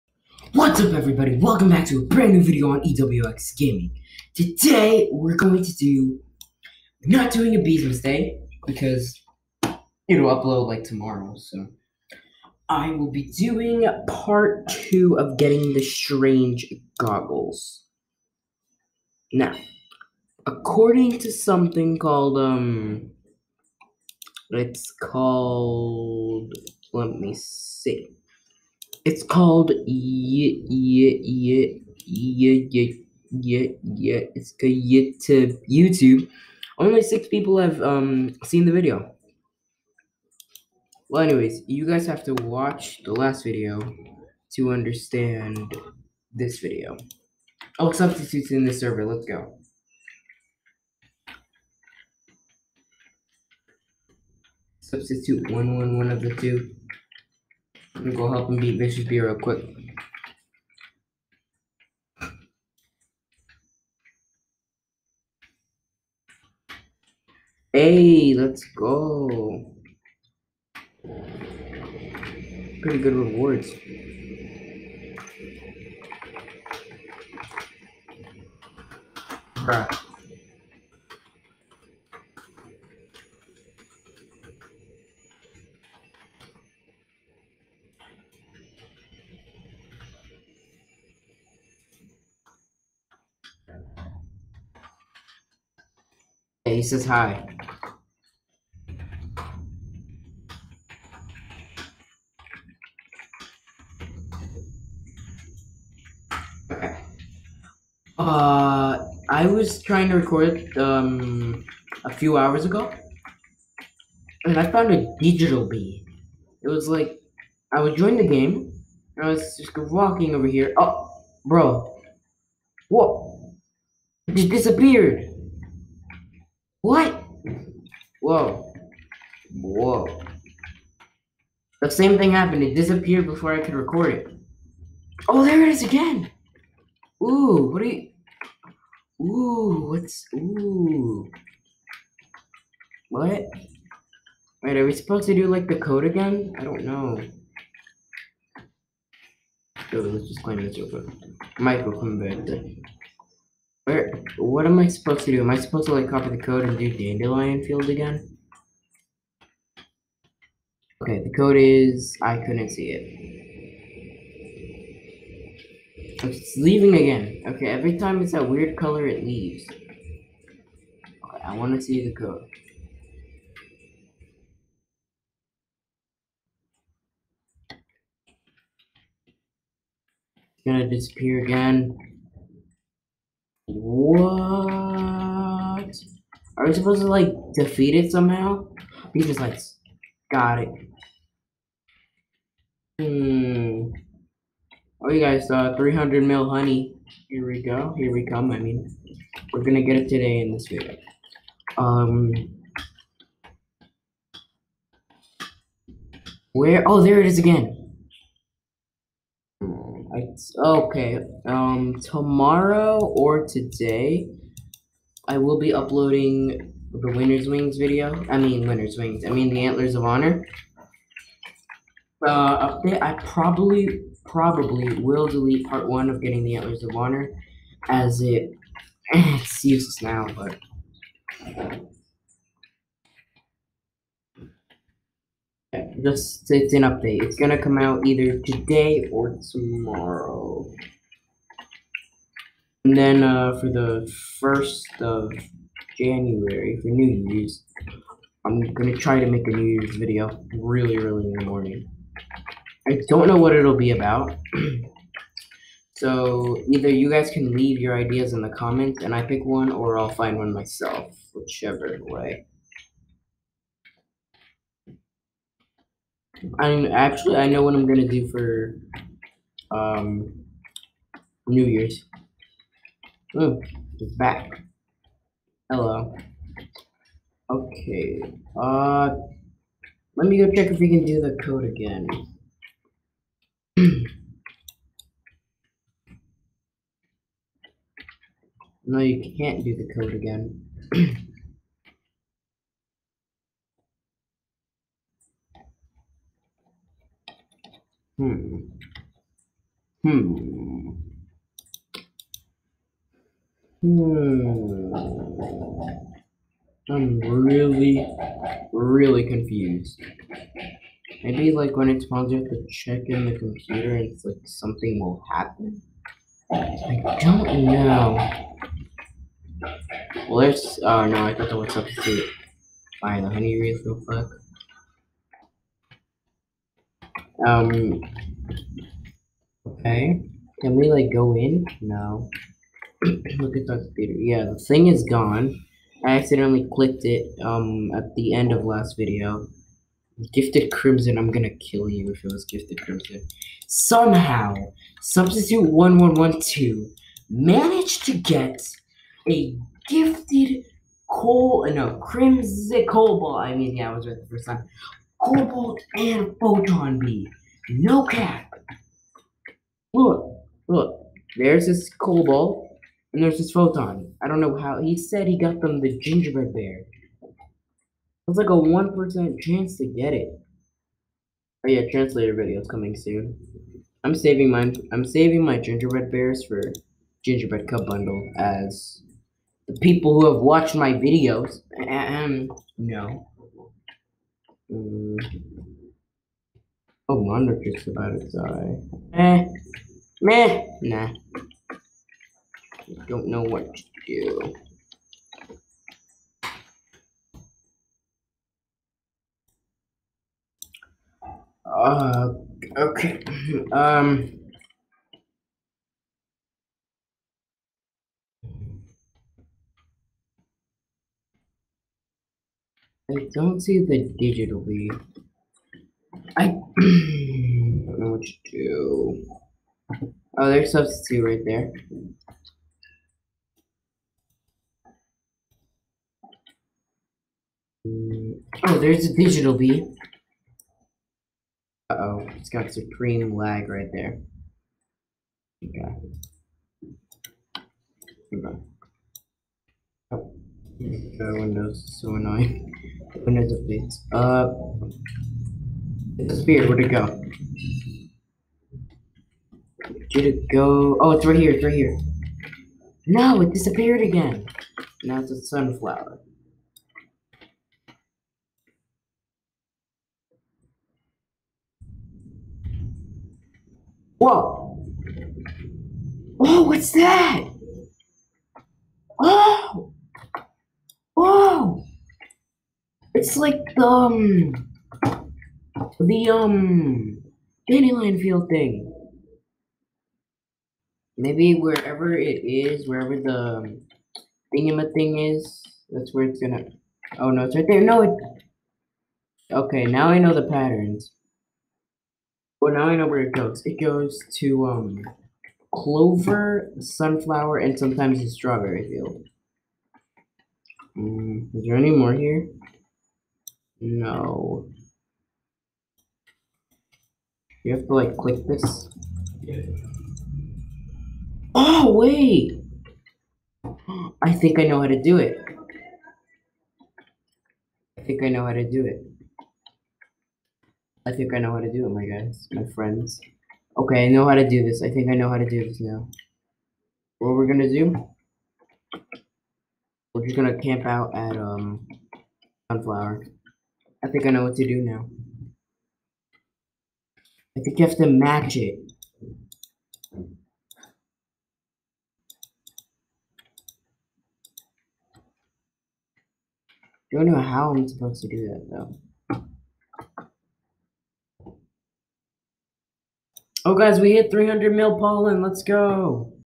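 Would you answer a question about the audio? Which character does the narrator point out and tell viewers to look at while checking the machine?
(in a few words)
Darth Vader.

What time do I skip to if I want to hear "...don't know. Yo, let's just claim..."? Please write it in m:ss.
2:26.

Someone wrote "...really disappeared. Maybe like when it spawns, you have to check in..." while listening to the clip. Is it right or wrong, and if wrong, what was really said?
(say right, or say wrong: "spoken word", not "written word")
wrong: "confused", not "disappeared".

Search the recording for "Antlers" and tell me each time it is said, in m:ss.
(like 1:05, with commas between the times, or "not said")
3:39, 3:46.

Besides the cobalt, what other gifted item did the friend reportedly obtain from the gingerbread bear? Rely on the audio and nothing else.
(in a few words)
Photon beam.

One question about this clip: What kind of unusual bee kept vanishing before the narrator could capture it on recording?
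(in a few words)
Digital bee.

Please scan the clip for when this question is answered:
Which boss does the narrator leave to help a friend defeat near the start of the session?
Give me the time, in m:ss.
0:58.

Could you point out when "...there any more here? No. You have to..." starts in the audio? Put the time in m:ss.
8:21.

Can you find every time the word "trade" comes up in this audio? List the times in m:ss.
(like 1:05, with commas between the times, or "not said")
not said.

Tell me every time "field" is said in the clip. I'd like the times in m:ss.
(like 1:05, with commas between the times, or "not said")
2:37, 7:58, 8:18.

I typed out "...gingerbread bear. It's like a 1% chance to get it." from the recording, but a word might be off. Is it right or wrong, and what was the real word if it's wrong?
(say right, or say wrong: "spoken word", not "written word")
right.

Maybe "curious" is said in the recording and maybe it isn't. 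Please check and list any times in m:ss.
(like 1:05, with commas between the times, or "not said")
not said.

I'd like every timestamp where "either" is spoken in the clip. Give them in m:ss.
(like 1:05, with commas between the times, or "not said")
3:58, 4:16.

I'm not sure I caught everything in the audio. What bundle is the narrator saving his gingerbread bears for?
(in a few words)
Gingerbread cup bundle.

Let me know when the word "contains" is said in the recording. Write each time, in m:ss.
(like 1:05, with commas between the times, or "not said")
not said.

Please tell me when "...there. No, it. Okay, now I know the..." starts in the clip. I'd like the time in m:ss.
8:07.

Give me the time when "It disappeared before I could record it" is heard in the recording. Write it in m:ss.
2:12.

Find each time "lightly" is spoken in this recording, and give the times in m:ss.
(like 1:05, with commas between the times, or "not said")
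not said.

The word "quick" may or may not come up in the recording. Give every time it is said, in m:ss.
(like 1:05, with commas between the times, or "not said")
0:59, 2:30, 5:24.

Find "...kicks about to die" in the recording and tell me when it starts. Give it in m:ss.
6:27.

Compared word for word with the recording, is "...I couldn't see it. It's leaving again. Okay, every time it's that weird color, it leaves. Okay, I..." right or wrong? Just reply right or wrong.
right.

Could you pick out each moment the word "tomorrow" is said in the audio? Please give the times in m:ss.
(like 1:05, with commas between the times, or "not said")
0:10, 3:32, 3:59.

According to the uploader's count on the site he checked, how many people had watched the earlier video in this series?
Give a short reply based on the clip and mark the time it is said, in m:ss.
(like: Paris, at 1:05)
6, at 0:37.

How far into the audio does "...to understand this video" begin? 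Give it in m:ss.
0:44.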